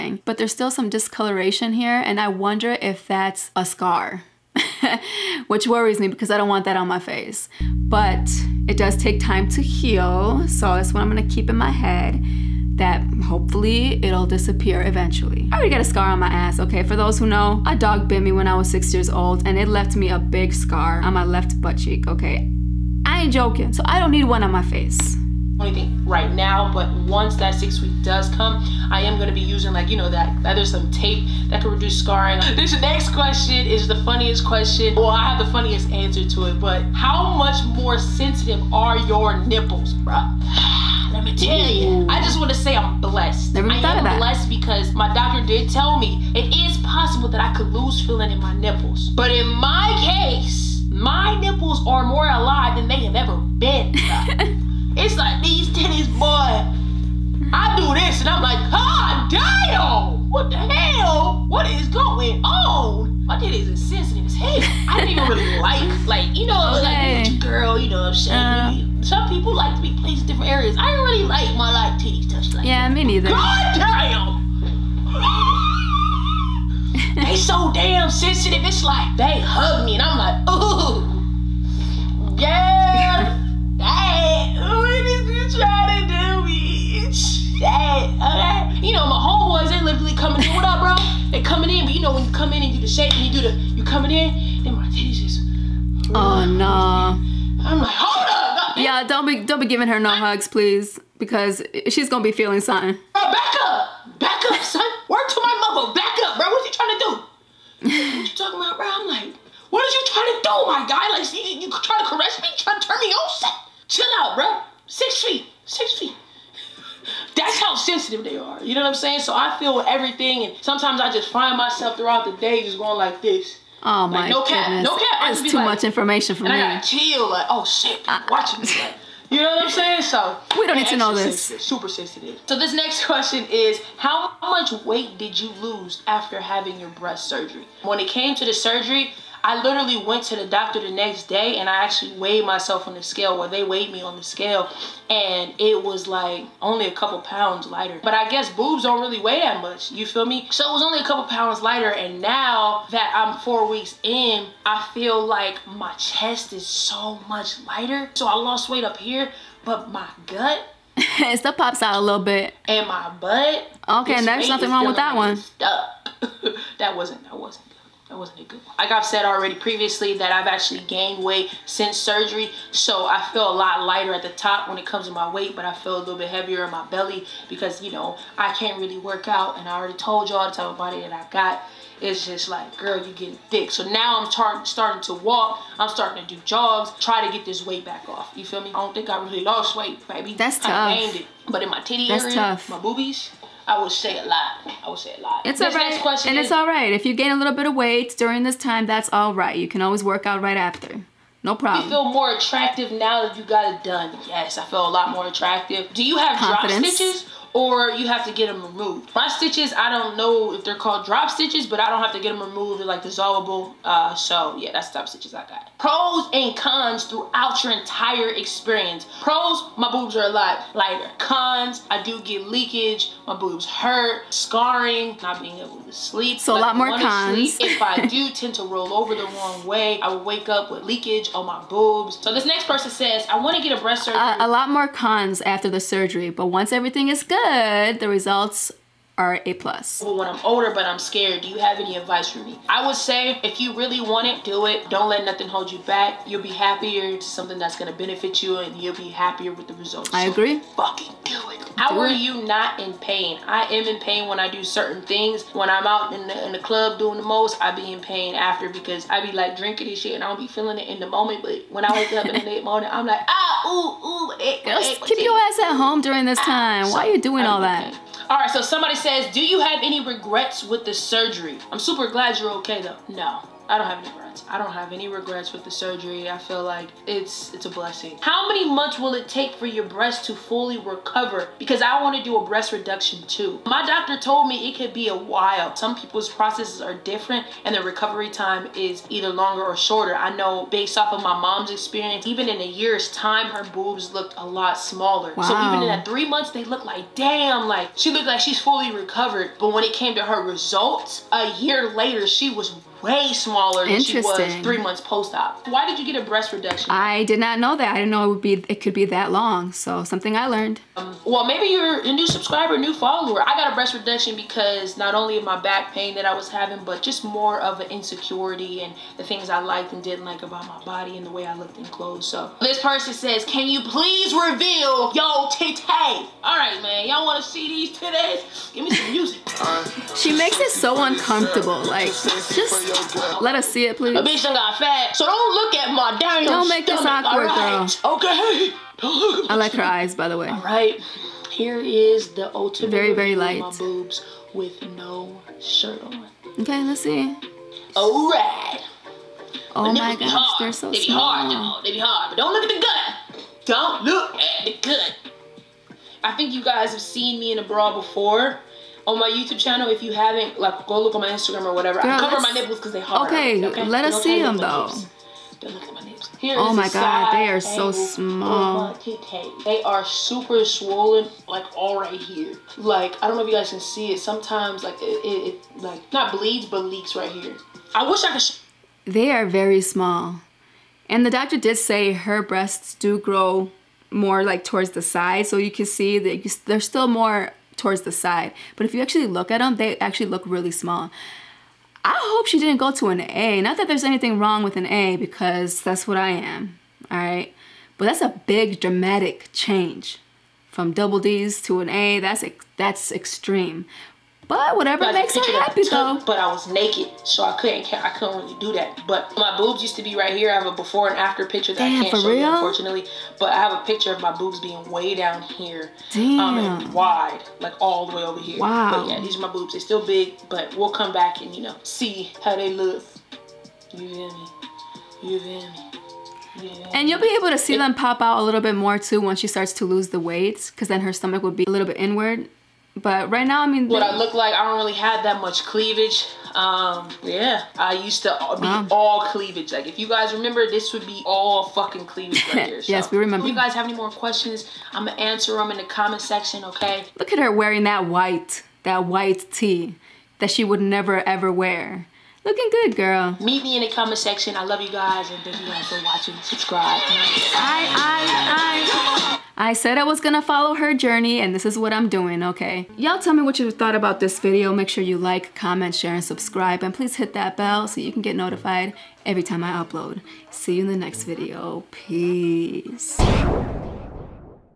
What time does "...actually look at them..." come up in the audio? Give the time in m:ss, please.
6:29.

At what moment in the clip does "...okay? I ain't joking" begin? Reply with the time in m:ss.
0:22.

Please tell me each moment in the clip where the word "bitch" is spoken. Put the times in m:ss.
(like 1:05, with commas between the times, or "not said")
1:26, 5:34.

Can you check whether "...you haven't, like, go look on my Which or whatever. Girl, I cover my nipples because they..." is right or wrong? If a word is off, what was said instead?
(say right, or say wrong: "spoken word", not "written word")
wrong: "Instagram", not "Which".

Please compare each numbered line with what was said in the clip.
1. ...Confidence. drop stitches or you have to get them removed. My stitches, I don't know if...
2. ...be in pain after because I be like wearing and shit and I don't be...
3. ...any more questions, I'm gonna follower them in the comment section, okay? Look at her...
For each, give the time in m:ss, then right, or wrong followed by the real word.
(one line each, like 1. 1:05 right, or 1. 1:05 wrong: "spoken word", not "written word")
1. 3:26 right
2. 4:17 wrong: "drinking", not "wearing"
3. 7:23 wrong: "answer", not "follower".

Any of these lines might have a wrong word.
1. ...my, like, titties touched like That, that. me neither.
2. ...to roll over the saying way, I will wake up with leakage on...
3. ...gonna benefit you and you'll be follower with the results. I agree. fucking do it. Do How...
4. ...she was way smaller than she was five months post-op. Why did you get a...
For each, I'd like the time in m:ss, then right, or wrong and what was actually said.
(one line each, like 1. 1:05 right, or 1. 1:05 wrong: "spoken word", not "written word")
1. 1:11 wrong: "Yeah", not "That"
2. 3:48 wrong: "wrong", not "saying"
3. 4:07 wrong: "happier", not "follower"
4. 5:02 wrong: "three", not "five".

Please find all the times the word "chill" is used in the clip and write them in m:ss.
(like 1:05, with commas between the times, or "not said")
1:53, 2:06.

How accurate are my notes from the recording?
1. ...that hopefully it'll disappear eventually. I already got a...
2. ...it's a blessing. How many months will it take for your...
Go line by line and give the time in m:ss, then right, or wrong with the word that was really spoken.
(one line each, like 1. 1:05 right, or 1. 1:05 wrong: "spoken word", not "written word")
1. 0:12 right
2. 4:37 right.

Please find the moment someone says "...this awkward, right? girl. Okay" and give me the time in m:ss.
5:37.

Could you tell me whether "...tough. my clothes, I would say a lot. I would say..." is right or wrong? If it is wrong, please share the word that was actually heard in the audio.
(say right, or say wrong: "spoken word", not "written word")
wrong: "boobies", not "clothes".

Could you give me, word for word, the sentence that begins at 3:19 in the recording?
You can always work out right after.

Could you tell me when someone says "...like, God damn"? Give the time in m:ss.
0:58.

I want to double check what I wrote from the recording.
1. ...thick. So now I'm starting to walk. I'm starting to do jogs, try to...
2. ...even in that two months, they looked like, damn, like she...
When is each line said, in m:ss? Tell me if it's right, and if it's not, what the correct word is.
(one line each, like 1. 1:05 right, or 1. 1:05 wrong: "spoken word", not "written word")
1. 3:03 right
2. 4:55 wrong: "three", not "two".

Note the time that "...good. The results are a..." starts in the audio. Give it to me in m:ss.
3:57.